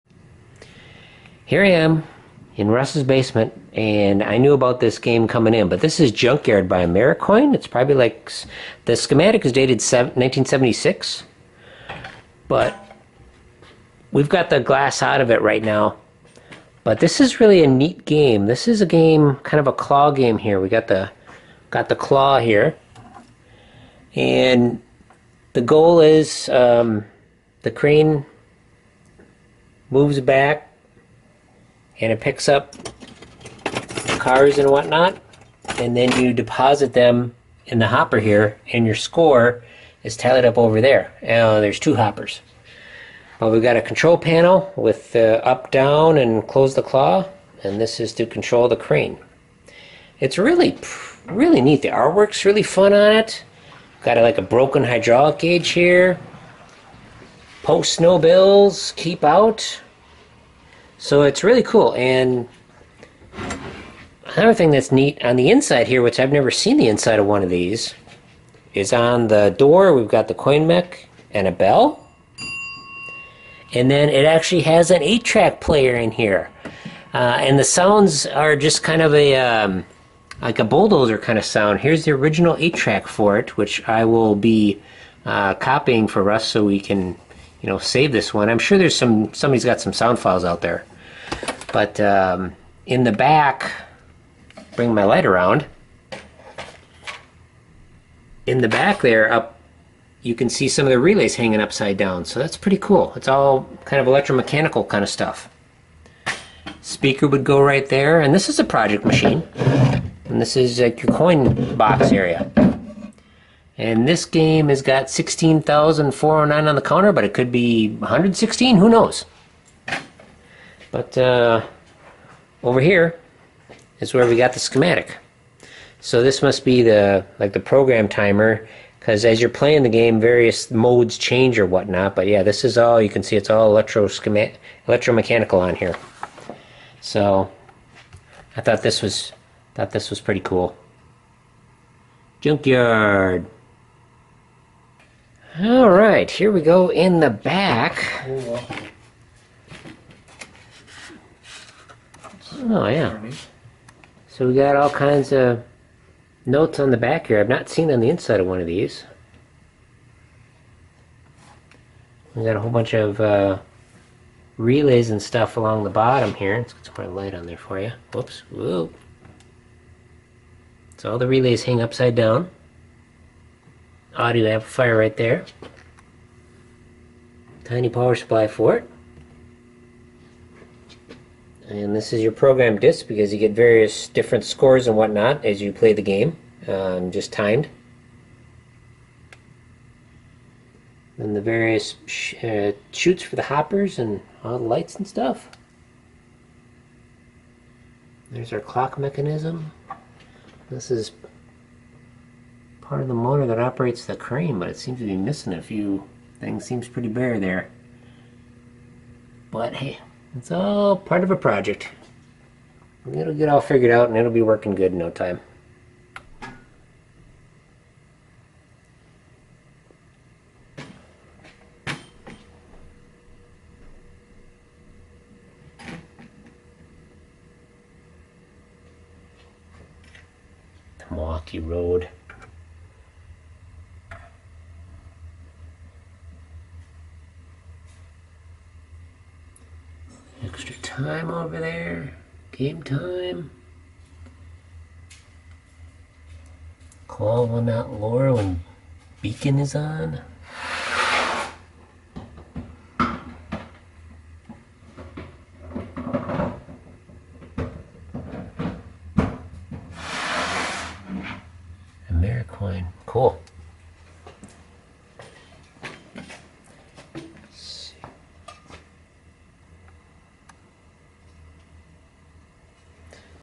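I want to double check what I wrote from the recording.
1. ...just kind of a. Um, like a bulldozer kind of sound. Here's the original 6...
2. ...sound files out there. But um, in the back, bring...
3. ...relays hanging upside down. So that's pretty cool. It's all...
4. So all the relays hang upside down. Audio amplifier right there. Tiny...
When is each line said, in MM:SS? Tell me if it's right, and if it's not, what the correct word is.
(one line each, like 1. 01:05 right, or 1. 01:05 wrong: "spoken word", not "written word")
1. 01:18 wrong: "8", not "6"
2. 01:29 right
3. 01:40 right
4. 02:50 right.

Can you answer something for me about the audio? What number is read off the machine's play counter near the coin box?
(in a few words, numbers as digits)
16,409.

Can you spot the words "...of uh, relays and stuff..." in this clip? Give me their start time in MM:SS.
02:42.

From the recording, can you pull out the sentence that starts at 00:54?
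Got a, like a broken hydraulic gauge here.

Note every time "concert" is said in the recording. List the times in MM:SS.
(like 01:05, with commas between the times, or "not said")
not said.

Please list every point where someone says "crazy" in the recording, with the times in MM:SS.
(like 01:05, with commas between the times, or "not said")
not said.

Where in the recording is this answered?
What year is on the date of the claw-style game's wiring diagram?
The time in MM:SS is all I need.
00:09.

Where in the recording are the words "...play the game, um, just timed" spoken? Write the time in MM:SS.
03:05.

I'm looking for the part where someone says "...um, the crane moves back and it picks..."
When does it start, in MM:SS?
00:26.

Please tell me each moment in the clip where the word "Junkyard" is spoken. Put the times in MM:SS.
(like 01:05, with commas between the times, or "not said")
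00:06, 02:22.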